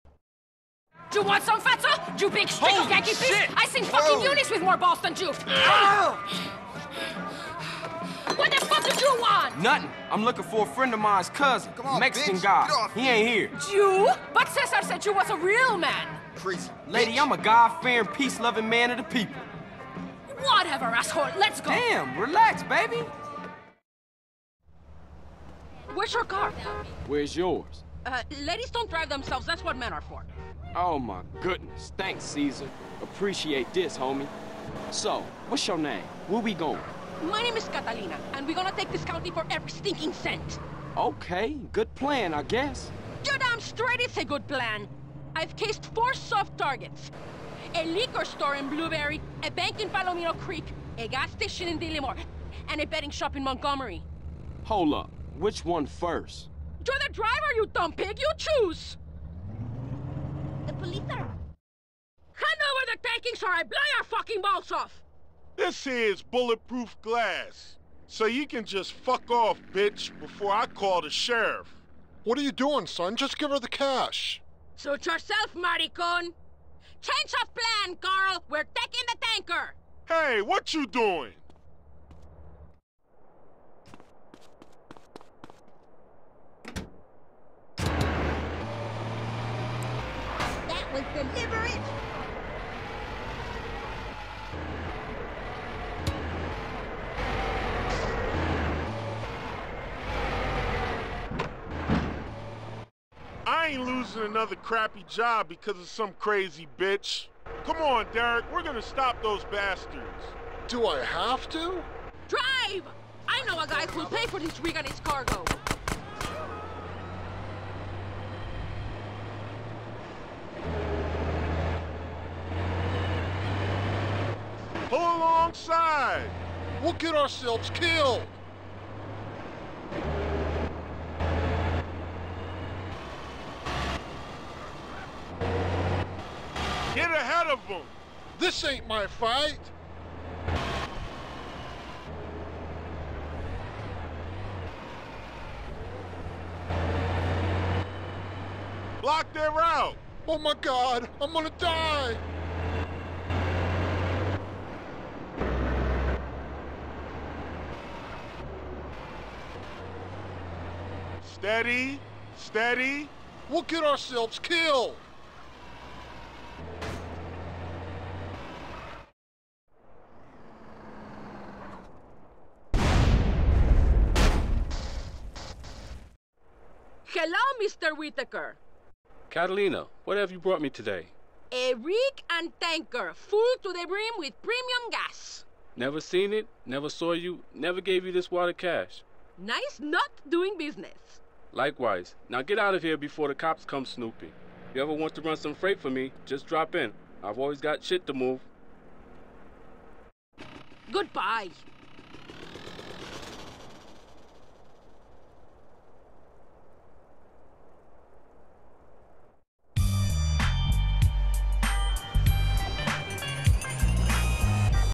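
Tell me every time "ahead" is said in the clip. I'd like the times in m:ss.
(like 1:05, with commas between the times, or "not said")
2:17.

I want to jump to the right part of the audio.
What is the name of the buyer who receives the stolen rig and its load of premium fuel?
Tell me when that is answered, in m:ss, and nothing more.
2:57.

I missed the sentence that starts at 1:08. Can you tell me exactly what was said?
So you can just fuck off, bitch, before I call the sheriff.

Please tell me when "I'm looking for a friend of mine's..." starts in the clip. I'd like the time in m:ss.
0:10.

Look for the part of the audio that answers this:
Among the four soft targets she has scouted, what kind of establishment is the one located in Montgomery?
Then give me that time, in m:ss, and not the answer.
0:52.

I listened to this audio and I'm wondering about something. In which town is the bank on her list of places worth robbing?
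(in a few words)
Palomino Creek.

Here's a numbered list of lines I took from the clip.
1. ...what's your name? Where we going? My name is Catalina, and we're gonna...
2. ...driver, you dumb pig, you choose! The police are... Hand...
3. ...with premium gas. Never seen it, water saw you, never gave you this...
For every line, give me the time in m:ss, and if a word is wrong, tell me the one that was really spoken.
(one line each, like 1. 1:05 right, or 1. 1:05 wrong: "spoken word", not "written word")
1. 0:35 right
2. 0:57 right
3. 3:04 wrong: "never", not "water".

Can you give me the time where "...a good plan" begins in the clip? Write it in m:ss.
0:44.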